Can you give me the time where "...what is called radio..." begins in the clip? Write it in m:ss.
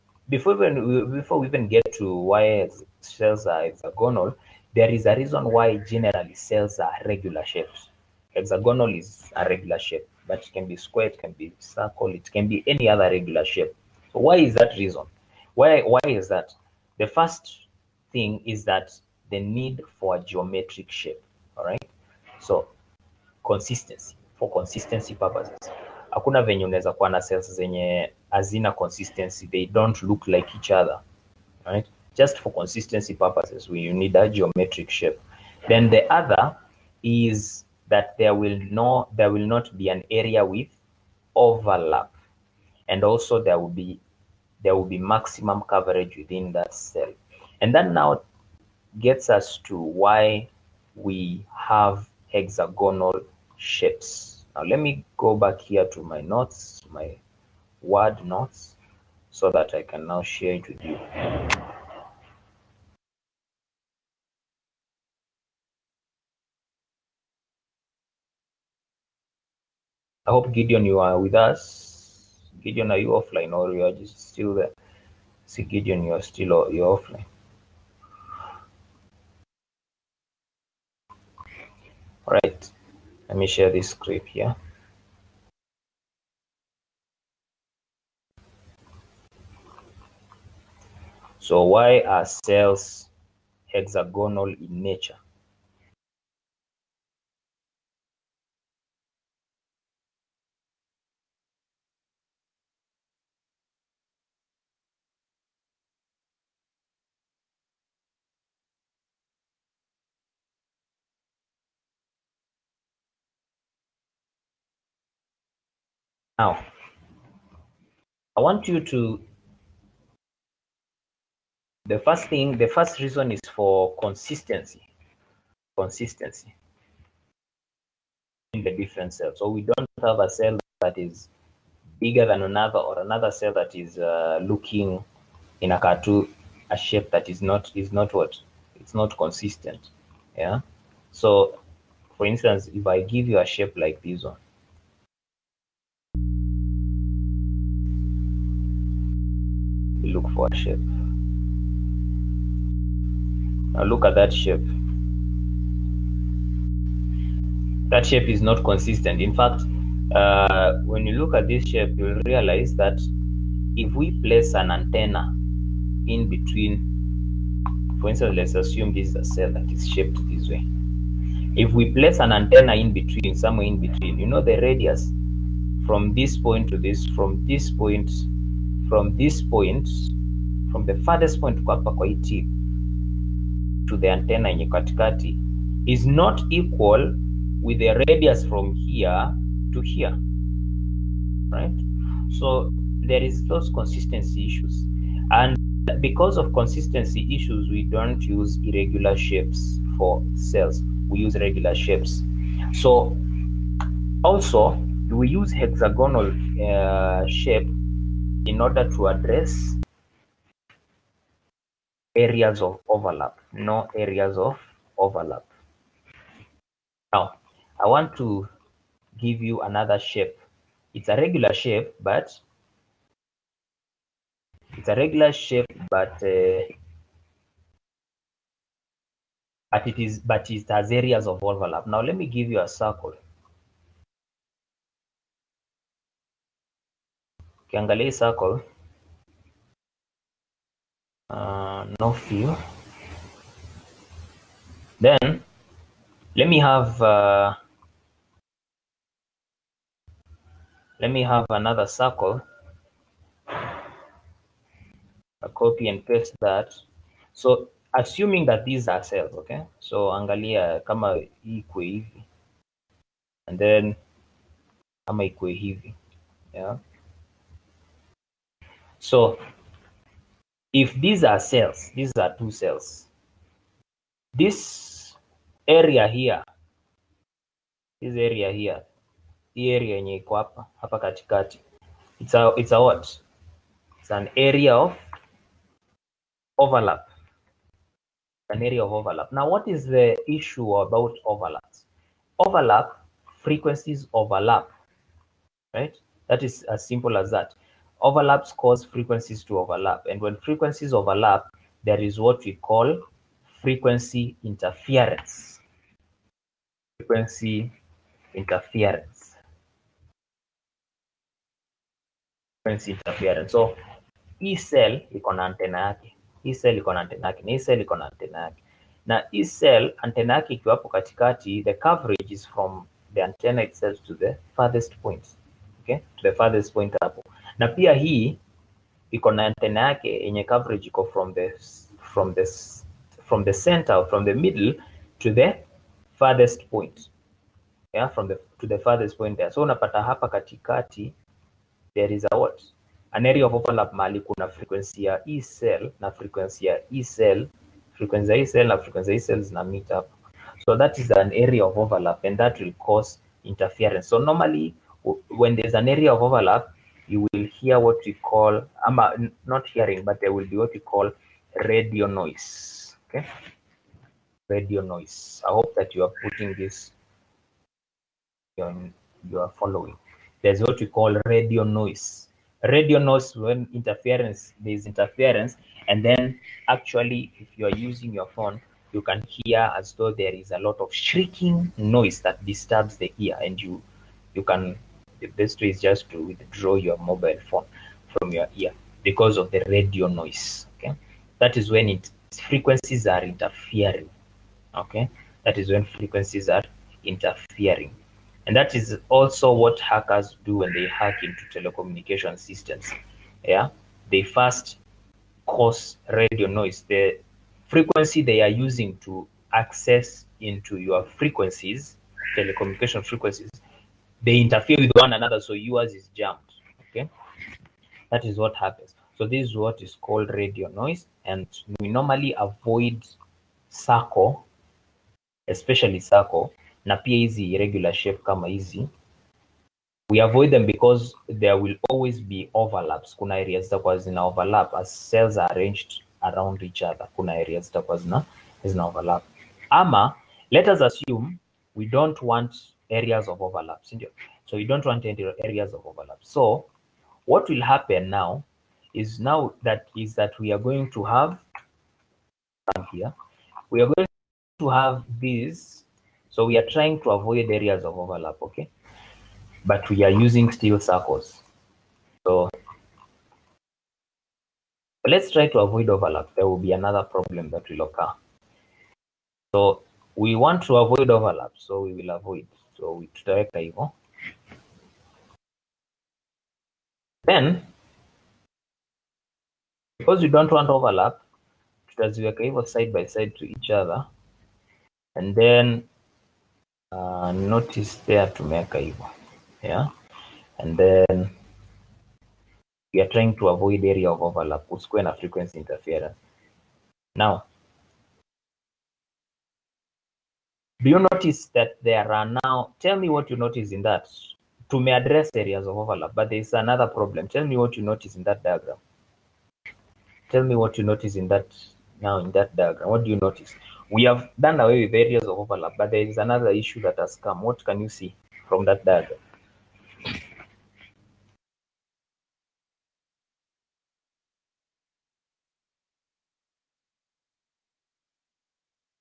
6:59.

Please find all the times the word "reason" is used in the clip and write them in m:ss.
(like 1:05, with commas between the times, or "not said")
0:05, 0:14, 2:03.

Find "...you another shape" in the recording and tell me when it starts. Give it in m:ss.
3:39.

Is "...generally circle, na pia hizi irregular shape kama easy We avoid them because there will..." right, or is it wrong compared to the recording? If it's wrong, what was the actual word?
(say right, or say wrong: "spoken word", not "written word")
wrong: "especially", not "generally".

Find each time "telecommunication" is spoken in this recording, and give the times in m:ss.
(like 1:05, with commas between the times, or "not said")
6:41, 6:52.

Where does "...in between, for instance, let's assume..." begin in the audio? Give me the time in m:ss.
2:46.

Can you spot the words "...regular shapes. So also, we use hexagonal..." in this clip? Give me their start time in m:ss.
3:21.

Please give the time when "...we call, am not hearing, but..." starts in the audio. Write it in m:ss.
5:58.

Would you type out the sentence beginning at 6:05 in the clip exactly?
I hope that you are putting this, you are following.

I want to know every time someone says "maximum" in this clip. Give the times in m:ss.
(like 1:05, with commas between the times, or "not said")
0:44.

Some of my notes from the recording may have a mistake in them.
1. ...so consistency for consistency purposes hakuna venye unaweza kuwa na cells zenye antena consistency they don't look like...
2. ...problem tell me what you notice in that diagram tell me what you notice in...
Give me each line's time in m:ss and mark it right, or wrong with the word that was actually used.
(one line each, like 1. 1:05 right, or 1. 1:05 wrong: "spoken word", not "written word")
1. 0:22 wrong: "hazina", not "antena"
2. 8:26 right.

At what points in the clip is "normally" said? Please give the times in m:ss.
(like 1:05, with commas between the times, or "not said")
5:54, 7:01.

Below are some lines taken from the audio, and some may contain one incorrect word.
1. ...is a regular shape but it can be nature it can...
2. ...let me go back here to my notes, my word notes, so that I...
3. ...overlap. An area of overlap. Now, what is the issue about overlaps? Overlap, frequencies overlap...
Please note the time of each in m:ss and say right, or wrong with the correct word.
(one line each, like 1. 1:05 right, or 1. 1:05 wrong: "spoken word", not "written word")
1. 0:09 wrong: "square", not "nature"
2. 0:54 right
3. 4:46 right.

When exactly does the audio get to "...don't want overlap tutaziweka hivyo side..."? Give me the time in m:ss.
8:00.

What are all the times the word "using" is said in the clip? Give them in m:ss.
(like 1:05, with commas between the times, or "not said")
6:17, 6:48, 7:40.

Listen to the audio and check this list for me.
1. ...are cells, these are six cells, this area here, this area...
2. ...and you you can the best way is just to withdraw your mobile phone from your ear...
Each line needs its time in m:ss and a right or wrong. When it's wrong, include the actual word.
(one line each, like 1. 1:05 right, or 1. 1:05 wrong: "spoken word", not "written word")
1. 4:31 wrong: "two", not "six"
2. 6:23 right.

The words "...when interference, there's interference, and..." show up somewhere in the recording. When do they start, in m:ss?
6:13.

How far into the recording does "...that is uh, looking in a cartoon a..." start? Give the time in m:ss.
2:13.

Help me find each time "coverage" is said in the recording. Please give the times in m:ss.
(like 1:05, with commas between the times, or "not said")
0:45, 5:21, 5:30.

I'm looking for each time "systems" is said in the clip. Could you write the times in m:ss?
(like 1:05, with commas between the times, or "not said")
6:42.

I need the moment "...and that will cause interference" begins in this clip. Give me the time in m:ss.
5:52.